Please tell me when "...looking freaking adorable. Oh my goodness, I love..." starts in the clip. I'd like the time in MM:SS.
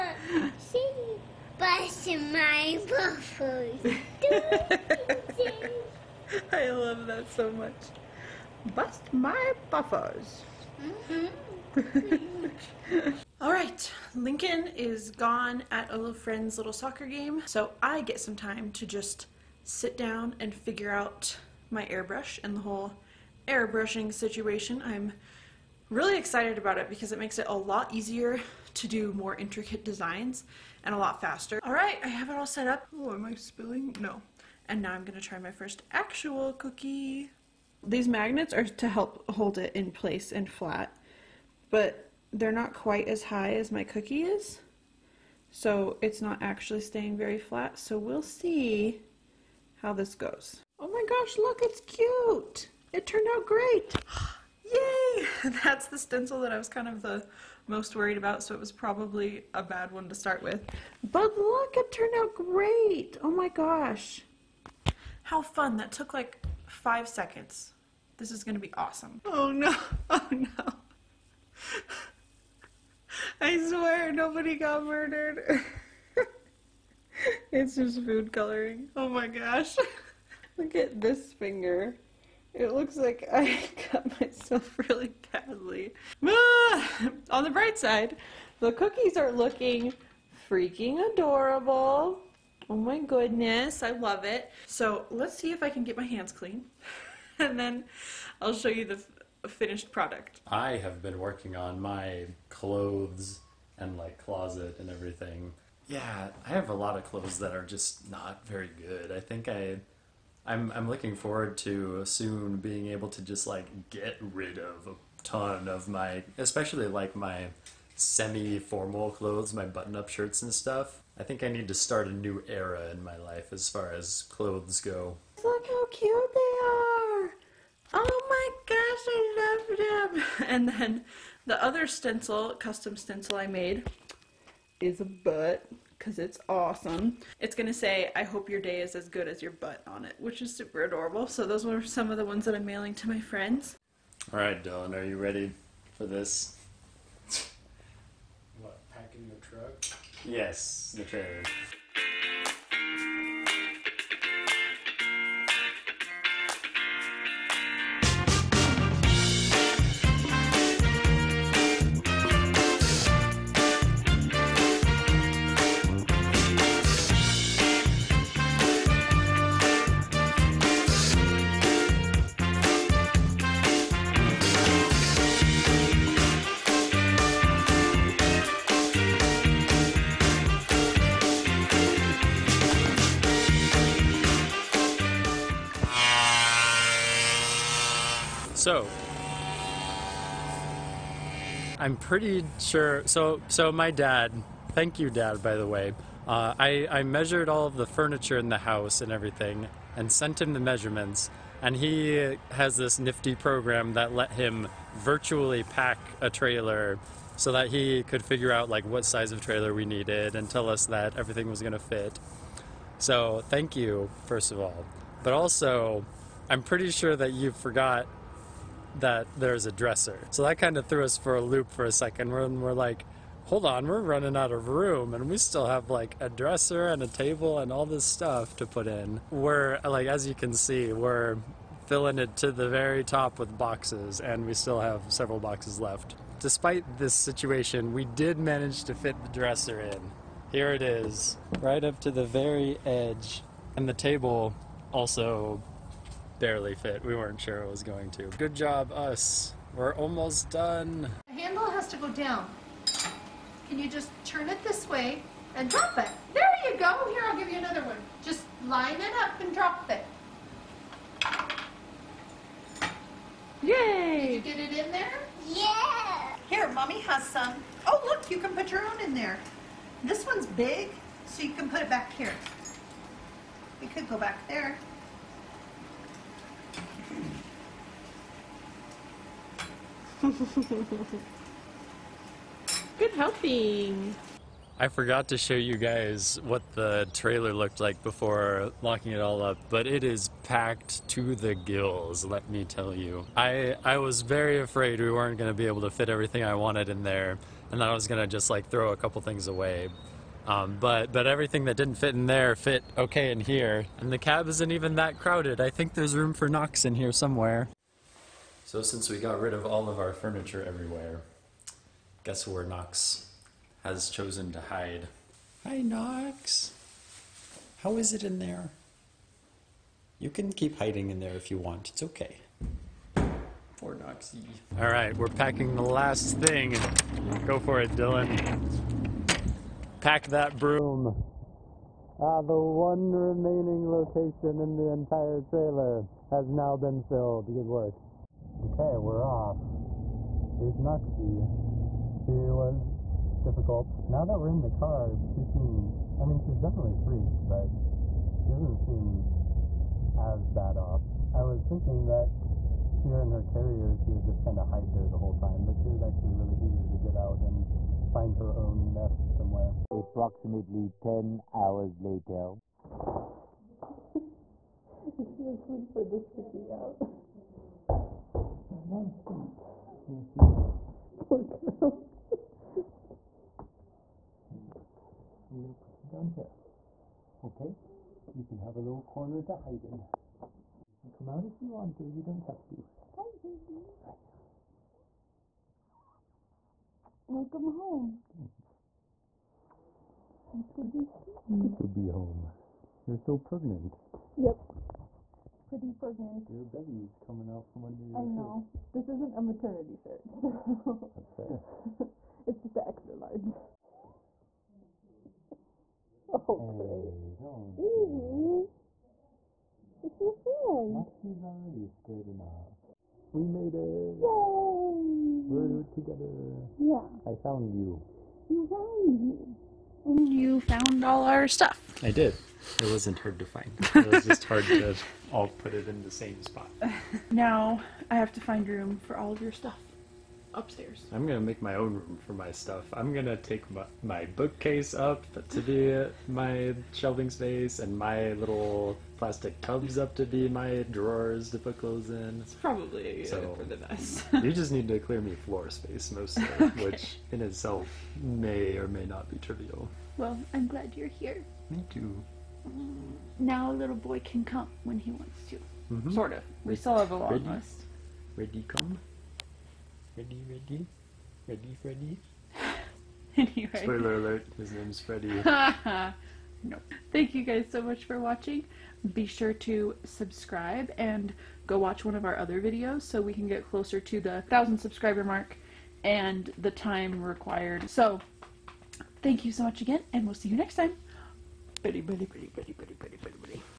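01:29.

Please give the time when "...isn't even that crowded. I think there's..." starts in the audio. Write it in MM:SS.
05:04.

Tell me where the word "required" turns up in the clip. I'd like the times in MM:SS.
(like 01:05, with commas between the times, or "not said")
07:57.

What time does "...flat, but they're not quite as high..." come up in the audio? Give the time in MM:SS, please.
00:40.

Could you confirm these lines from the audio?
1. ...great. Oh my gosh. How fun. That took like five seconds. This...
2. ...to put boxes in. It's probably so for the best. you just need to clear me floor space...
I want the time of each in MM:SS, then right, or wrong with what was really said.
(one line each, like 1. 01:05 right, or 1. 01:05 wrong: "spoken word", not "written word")
1. 01:02 right
2. 07:21 wrong: "clothes", not "boxes".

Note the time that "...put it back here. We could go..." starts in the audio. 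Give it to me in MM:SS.
04:31.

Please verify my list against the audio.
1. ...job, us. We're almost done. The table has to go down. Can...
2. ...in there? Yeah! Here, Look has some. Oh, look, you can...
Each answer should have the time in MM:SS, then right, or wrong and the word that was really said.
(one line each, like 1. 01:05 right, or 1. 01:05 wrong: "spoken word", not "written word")
1. 04:08 wrong: "handle", not "table"
2. 04:24 wrong: "Mommy", not "Look".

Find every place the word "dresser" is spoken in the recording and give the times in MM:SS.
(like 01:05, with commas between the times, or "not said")
03:39, 03:46, 03:59.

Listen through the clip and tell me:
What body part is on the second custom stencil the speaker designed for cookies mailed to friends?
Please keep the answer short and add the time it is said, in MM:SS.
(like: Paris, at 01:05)
A butt, at 02:14.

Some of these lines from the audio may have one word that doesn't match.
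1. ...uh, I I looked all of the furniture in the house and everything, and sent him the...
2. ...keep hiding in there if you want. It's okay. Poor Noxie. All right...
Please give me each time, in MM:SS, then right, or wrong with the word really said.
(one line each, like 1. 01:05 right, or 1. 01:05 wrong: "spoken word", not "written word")
1. 03:16 wrong: "measured", not "looked"
2. 05:20 right.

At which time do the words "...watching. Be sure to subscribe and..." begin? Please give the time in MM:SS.
07:48.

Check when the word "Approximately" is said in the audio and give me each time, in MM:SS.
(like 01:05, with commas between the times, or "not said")
05:59.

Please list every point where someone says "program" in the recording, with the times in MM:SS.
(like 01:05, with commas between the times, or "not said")
03:23.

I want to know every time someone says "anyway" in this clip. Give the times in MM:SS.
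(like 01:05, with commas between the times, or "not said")
07:43.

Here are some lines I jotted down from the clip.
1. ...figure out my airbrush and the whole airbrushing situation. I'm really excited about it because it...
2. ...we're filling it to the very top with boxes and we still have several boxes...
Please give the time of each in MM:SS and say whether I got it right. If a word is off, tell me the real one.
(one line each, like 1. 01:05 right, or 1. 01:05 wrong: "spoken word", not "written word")
1. 00:20 right
2. 03:50 right.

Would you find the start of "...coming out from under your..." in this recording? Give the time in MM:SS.
06:37.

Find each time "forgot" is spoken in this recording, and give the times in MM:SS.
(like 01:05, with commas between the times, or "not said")
03:37, 04:44.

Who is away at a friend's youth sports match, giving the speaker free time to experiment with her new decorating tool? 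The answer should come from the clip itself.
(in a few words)
Lincoln.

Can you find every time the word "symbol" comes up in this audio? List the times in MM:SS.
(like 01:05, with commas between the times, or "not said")
not said.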